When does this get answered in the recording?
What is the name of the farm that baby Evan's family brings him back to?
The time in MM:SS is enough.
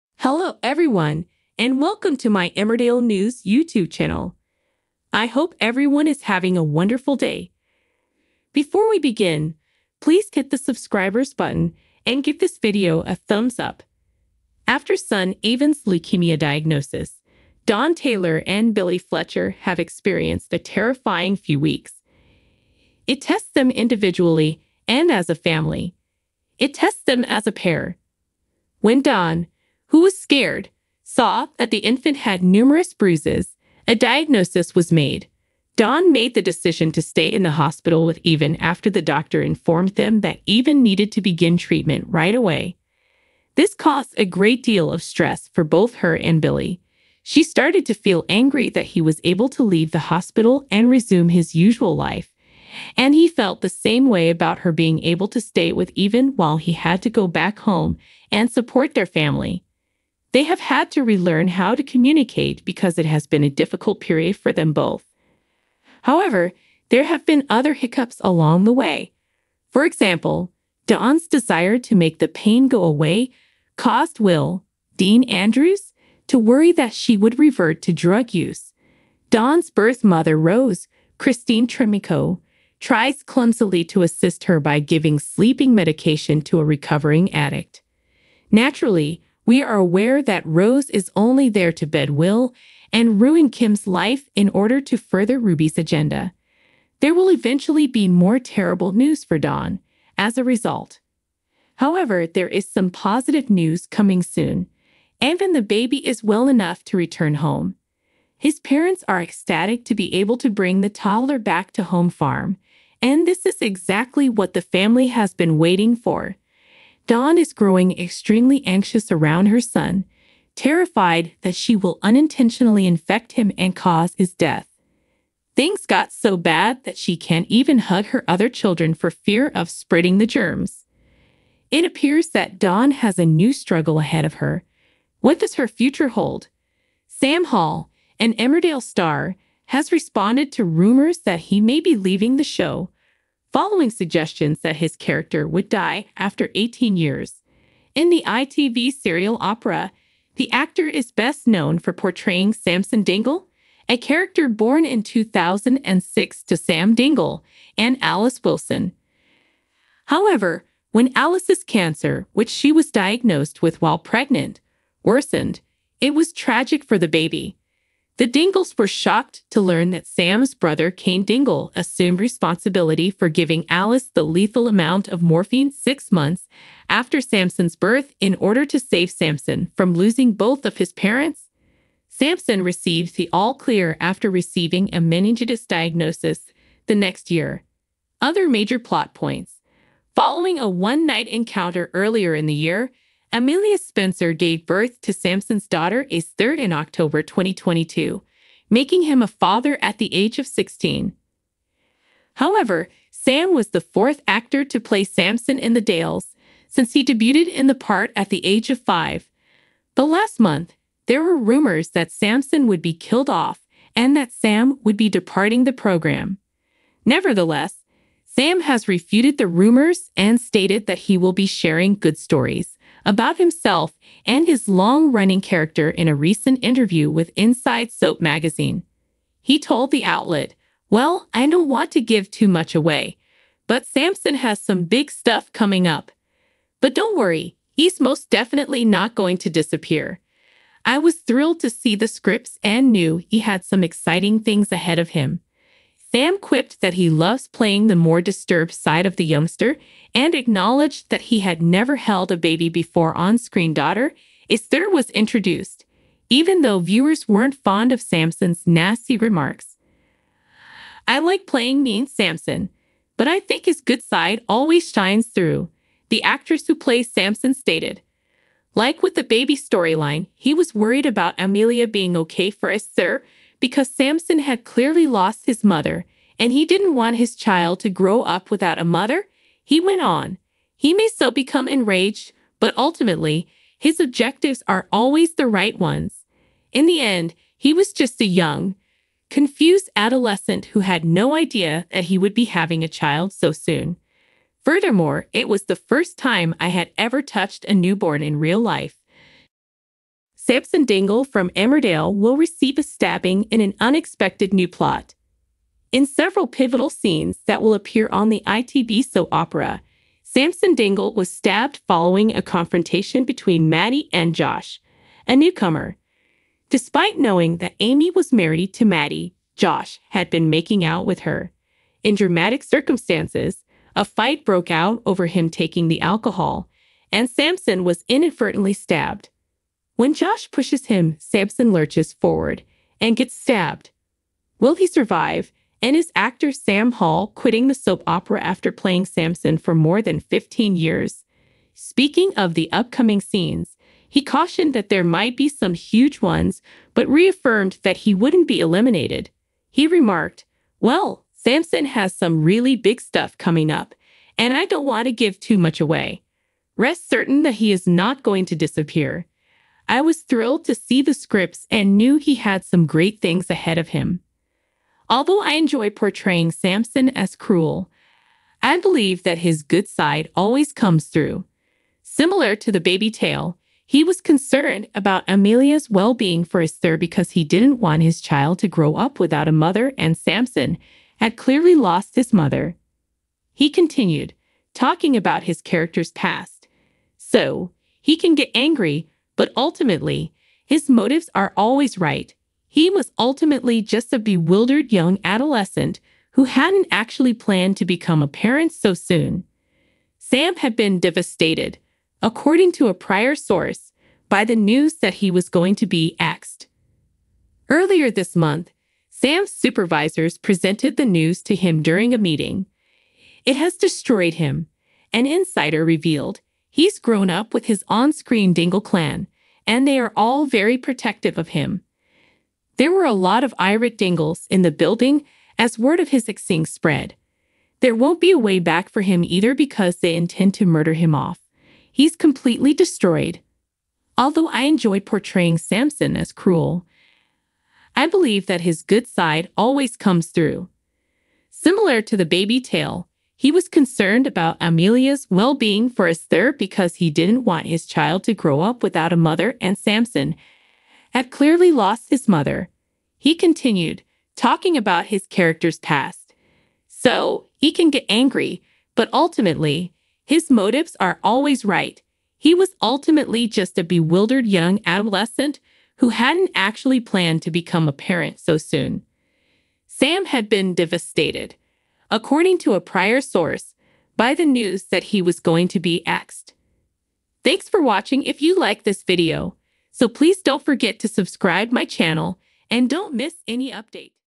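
01:51.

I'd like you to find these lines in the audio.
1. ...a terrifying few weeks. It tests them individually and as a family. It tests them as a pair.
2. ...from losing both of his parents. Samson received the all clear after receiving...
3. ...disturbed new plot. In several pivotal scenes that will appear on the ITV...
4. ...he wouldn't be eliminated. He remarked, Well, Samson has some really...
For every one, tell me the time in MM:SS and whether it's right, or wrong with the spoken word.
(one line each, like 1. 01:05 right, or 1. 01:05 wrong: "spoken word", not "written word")
1. 00:20 right
2. 02:59 right
3. 05:03 wrong: "unexpected", not "disturbed"
4. 05:47 right.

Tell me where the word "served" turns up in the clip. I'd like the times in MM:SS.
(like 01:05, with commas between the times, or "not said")
not said.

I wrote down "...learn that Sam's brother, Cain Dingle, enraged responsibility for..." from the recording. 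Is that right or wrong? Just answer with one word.
wrong.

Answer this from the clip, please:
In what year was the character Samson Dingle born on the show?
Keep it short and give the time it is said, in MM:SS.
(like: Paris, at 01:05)
2006, at 02:35.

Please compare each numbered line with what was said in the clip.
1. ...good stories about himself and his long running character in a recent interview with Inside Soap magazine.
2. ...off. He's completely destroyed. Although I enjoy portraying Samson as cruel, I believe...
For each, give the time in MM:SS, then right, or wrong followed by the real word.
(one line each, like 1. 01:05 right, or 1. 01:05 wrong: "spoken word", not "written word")
1. 03:41 right
2. 07:11 right.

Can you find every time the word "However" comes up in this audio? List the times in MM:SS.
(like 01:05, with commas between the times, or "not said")
01:06, 01:41, 02:40, 03:22.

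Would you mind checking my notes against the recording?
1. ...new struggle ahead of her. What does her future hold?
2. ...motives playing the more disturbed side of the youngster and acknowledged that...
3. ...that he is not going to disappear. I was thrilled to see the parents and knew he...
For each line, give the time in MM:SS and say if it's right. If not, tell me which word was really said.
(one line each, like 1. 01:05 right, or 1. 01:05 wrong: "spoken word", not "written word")
1. 02:13 right
2. 04:07 wrong: "loves", not "motives"
3. 05:57 wrong: "scripts", not "parents".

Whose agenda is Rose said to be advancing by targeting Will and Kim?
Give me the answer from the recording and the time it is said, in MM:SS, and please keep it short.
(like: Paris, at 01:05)
Ruby, at 01:35.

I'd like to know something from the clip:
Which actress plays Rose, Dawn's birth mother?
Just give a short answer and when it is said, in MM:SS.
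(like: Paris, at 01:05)
Christine Tremarco, at 01:21.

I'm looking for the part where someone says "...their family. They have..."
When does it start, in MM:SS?
00:58.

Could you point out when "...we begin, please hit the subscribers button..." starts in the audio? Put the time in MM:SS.
00:08.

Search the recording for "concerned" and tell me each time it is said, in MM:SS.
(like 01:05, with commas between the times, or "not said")
06:14, 07:23.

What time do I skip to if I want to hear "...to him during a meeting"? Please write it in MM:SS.
06:51.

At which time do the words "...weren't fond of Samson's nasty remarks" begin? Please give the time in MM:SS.
04:17.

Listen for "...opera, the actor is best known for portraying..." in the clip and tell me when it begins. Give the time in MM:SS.
02:29.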